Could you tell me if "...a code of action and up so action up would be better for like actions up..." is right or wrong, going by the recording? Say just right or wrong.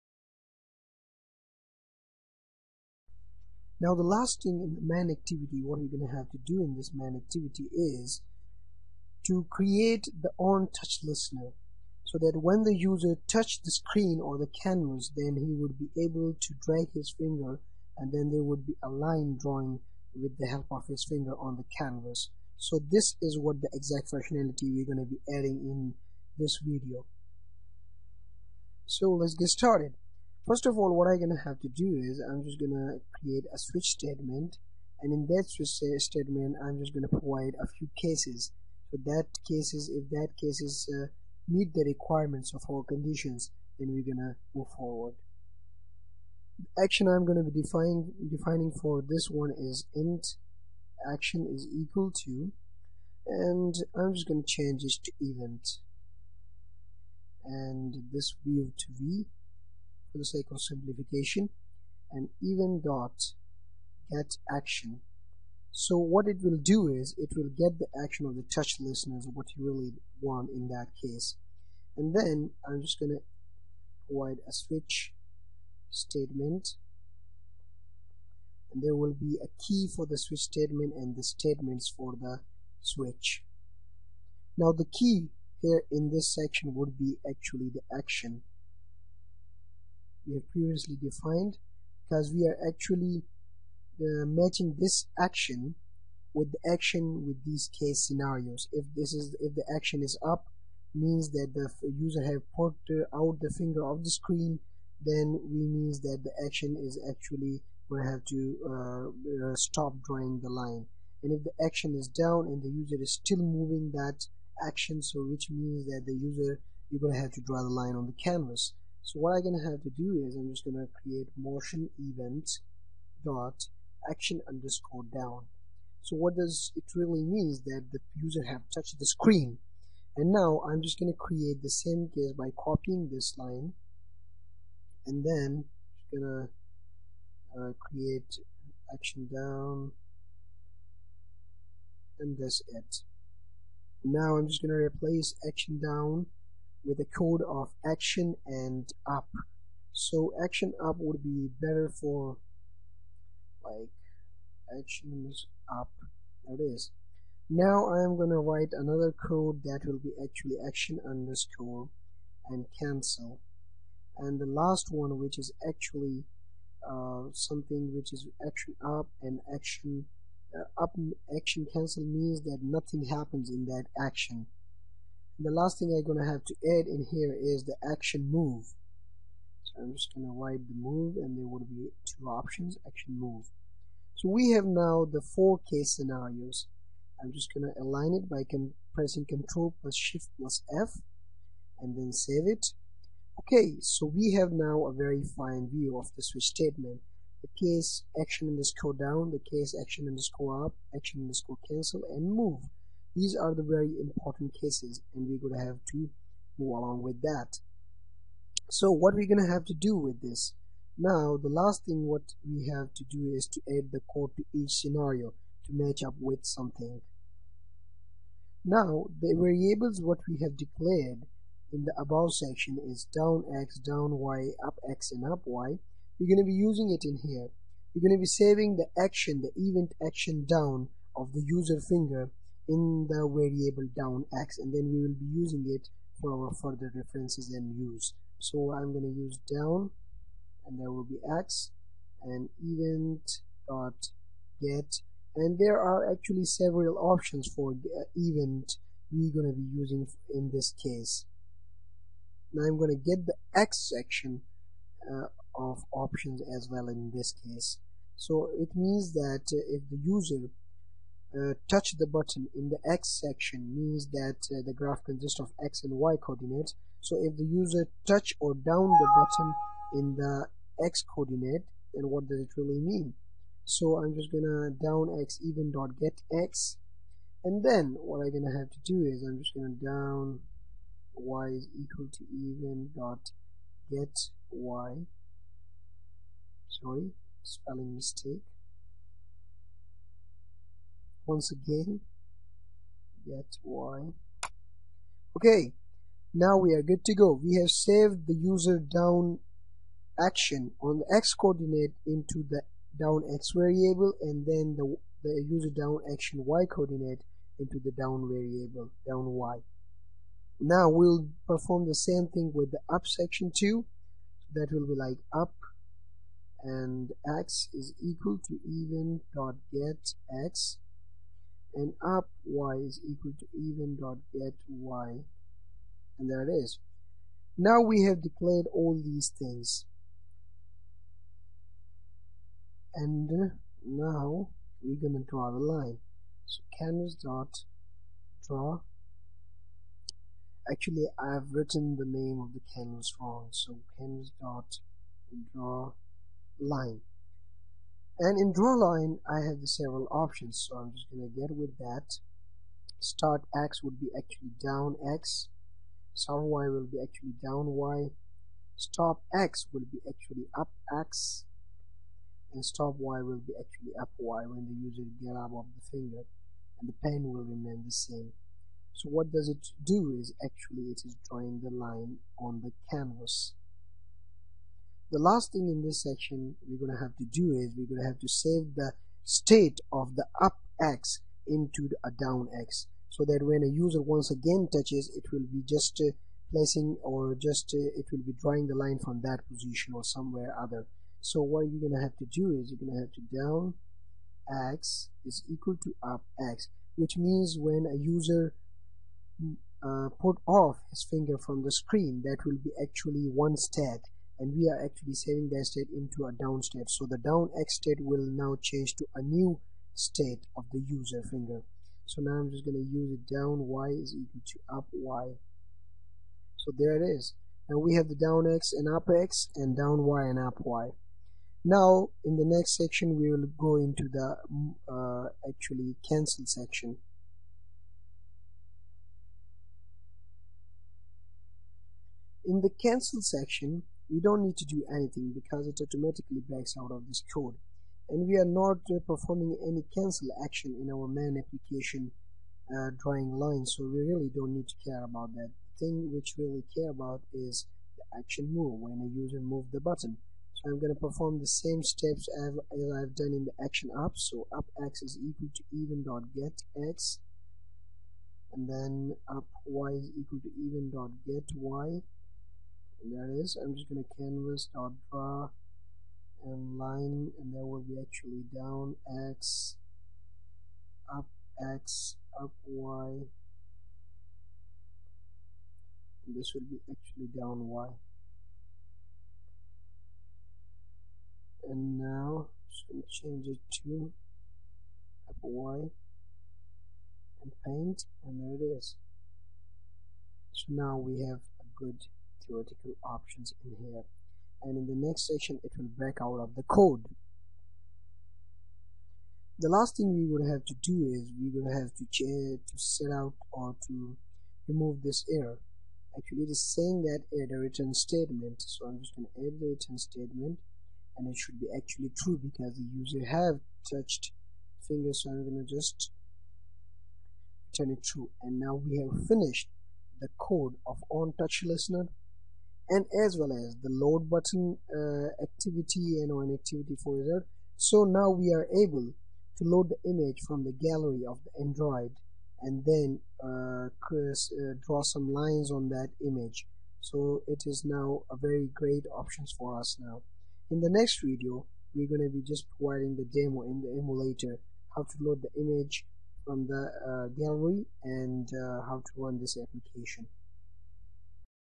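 right.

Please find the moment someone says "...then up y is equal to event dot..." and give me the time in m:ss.
7:38.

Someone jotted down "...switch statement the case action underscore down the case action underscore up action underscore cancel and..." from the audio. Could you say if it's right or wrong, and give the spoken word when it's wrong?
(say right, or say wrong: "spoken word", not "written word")
right.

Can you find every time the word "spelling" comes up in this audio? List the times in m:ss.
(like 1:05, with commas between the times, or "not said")
4:47.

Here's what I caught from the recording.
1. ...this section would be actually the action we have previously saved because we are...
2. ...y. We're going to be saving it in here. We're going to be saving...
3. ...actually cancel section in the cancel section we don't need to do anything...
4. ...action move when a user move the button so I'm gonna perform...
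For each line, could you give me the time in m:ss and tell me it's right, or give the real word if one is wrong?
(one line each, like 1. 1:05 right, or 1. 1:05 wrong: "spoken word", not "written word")
1. 1:26 wrong: "defined", not "saved"
2. 3:45 wrong: "using", not "saving"
3. 7:05 right
4. 7:28 right.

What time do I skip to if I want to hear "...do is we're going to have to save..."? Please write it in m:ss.
6:17.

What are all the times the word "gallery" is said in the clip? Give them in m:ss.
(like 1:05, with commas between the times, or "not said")
8:50, 9:07.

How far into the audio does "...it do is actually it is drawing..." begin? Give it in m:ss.
6:09.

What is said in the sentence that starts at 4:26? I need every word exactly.
So if the user touch or down the button in the X coordinate, then what does it really mean?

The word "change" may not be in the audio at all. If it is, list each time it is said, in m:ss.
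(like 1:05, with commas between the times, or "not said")
0:54, 6:48, 8:03.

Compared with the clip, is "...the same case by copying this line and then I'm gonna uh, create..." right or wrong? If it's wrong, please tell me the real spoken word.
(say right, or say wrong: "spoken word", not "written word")
right.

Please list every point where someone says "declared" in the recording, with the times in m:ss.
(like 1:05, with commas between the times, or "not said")
3:40, 5:28.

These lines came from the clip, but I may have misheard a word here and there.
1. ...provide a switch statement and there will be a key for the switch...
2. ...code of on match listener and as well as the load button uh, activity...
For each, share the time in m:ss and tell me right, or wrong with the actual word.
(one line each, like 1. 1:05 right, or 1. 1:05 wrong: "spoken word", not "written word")
1. 1:14 right
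2. 8:40 wrong: "touch", not "match".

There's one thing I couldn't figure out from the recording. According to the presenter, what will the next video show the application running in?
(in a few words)
the emulator.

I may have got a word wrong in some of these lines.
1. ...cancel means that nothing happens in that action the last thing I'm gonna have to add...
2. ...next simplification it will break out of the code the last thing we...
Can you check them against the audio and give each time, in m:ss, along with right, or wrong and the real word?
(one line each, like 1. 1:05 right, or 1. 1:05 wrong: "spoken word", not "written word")
1. 2:51 right
2. 8:15 wrong: "section", not "simplification".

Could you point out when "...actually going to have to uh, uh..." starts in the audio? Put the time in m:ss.
1:47.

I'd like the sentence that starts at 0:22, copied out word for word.
So this is what the exact functionality we're going to be adding in this video.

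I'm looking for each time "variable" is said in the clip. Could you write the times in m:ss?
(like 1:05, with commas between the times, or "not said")
3:39, 3:53, 5:03, 5:08.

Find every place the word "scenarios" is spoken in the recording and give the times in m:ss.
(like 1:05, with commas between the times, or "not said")
1:38, 3:05, 3:34.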